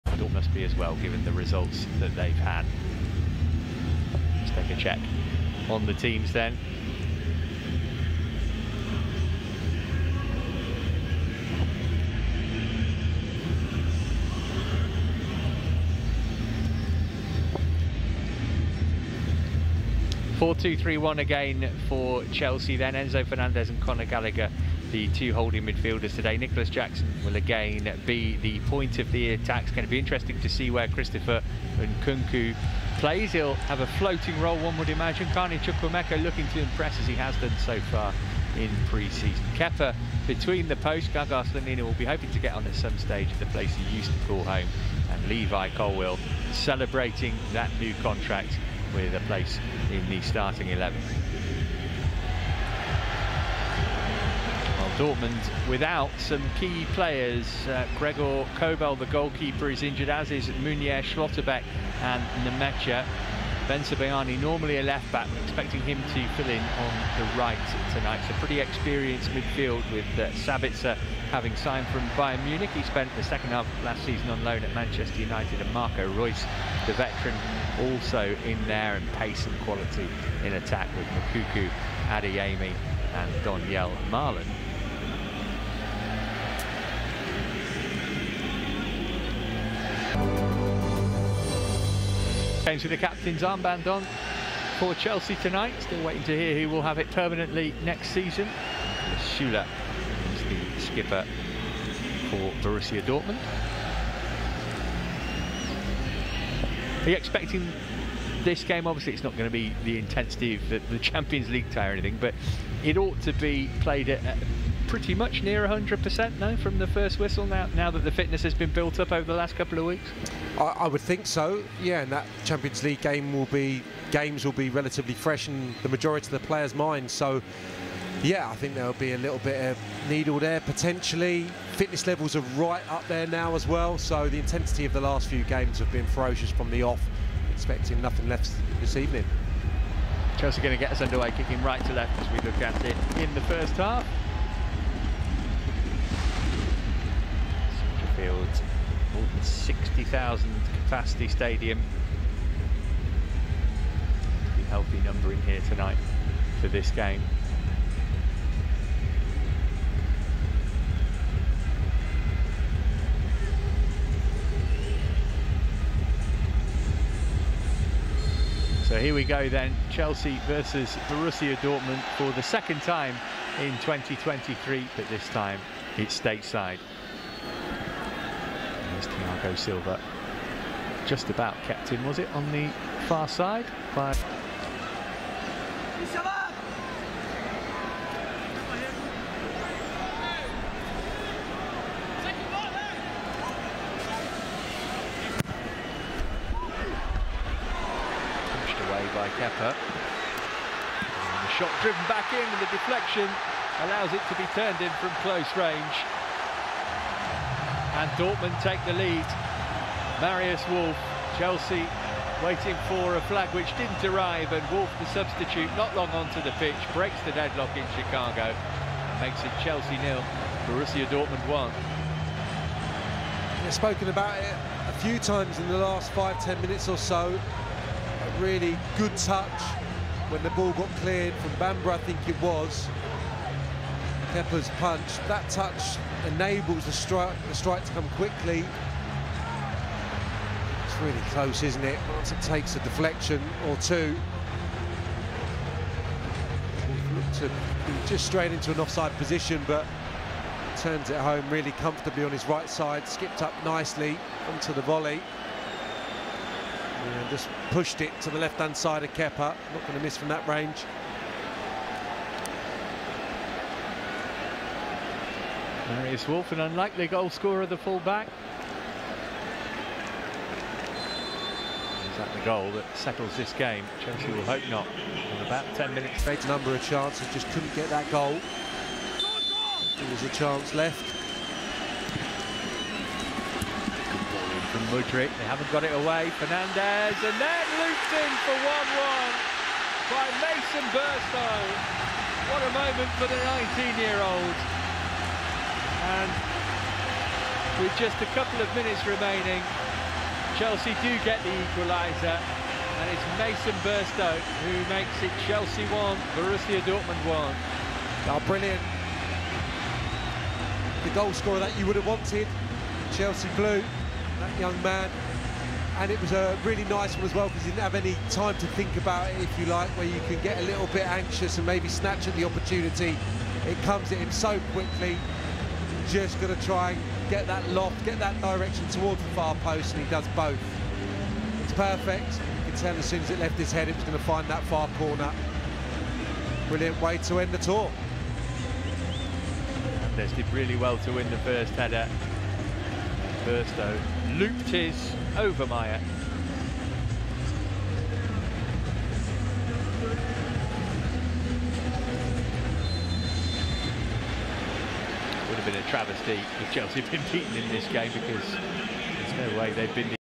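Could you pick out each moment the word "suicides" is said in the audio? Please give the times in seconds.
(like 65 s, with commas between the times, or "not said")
not said.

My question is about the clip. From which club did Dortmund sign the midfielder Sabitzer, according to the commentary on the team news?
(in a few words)
Bayern Munich.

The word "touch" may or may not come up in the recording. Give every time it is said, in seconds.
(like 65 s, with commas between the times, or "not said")
229 s, 235 s.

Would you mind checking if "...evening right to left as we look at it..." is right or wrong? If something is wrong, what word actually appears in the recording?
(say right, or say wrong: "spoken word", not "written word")
wrong: "kicking", not "evening".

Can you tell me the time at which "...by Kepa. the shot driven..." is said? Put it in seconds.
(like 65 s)
199 s.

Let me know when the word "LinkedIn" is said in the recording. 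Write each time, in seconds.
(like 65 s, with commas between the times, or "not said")
not said.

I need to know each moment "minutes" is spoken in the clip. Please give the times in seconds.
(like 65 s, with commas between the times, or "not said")
226 s, 275 s, 298 s.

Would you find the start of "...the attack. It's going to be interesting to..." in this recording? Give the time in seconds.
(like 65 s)
29 s.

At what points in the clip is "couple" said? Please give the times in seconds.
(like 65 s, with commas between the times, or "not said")
119 s, 298 s.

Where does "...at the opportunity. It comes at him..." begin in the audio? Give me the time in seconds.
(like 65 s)
322 s.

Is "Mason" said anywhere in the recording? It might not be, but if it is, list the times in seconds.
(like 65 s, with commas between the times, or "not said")
290 s, 303 s.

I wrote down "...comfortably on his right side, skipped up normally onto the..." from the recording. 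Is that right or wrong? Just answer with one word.
wrong.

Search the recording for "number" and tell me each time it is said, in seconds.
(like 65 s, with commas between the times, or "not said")
155 s, 276 s.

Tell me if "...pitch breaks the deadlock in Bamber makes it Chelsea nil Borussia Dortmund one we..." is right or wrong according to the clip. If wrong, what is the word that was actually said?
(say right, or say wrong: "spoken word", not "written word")
wrong: "Chicago", not "Bamber".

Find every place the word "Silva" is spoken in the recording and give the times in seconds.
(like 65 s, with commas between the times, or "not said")
179 s.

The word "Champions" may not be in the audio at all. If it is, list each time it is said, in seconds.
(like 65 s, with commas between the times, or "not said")
110 s, 122 s.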